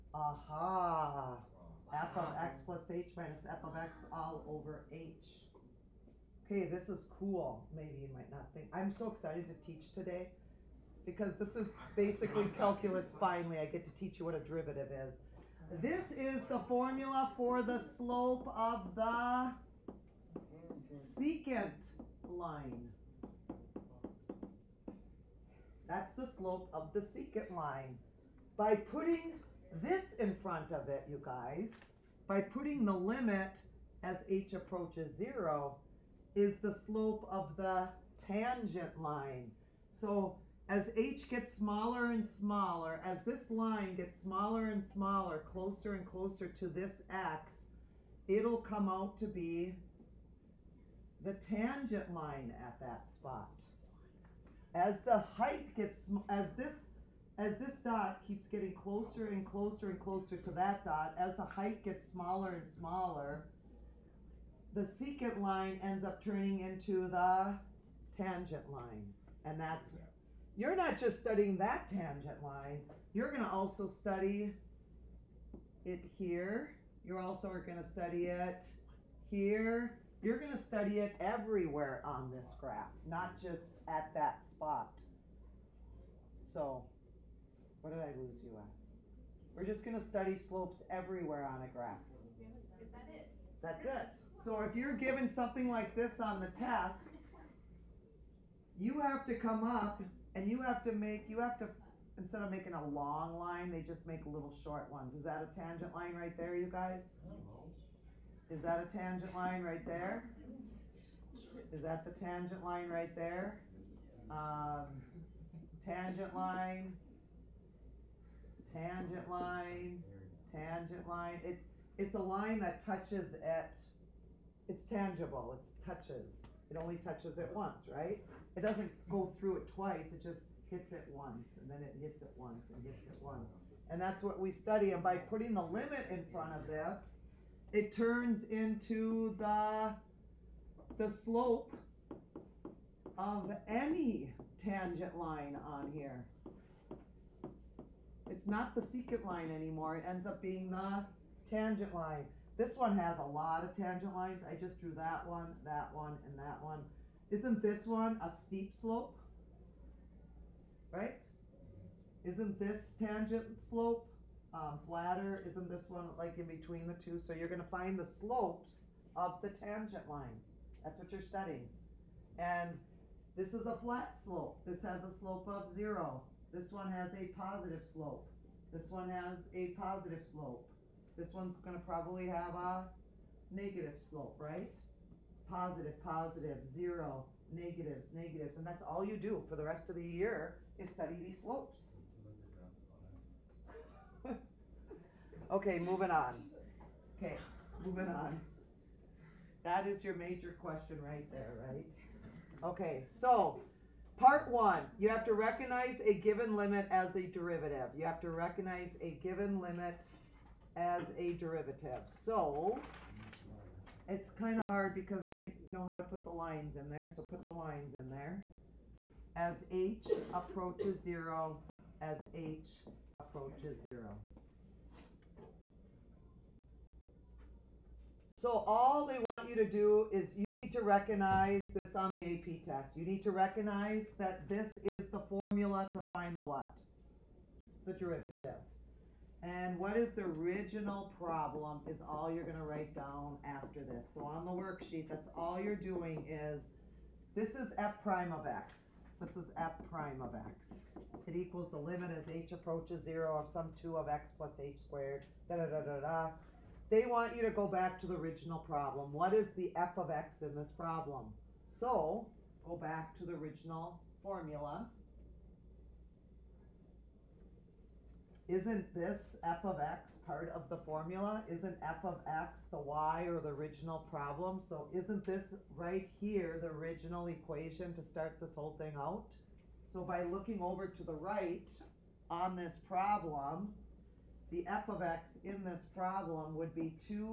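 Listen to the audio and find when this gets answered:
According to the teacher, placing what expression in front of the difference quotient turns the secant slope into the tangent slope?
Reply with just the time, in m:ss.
0:32.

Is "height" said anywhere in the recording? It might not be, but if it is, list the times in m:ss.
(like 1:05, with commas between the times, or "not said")
0:55, 1:01.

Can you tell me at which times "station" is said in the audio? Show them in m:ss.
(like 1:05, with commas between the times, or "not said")
not said.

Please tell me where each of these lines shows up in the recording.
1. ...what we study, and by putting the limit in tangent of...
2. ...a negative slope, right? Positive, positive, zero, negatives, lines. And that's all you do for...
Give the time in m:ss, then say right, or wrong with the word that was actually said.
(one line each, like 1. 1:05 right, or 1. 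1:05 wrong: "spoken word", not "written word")
1. 2:14 wrong: "front", not "tangent"
2. 3:02 wrong: "negatives", not "lines".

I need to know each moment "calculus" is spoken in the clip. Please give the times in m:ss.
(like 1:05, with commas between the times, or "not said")
0:12.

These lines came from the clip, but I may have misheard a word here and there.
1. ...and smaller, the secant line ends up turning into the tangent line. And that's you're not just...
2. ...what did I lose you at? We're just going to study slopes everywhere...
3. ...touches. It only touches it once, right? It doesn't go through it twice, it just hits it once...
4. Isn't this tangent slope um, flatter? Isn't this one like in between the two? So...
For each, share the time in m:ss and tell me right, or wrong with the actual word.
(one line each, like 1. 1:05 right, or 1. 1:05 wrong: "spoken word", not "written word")
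1. 1:02 right
2. 1:27 right
3. 2:05 right
4. 2:42 right.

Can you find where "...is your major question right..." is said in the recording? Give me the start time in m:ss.
3:19.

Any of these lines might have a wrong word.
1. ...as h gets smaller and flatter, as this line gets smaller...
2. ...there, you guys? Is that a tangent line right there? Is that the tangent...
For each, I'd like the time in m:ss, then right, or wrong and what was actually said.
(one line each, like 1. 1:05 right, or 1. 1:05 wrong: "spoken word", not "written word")
1. 0:40 wrong: "smaller", not "flatter"
2. 1:46 right.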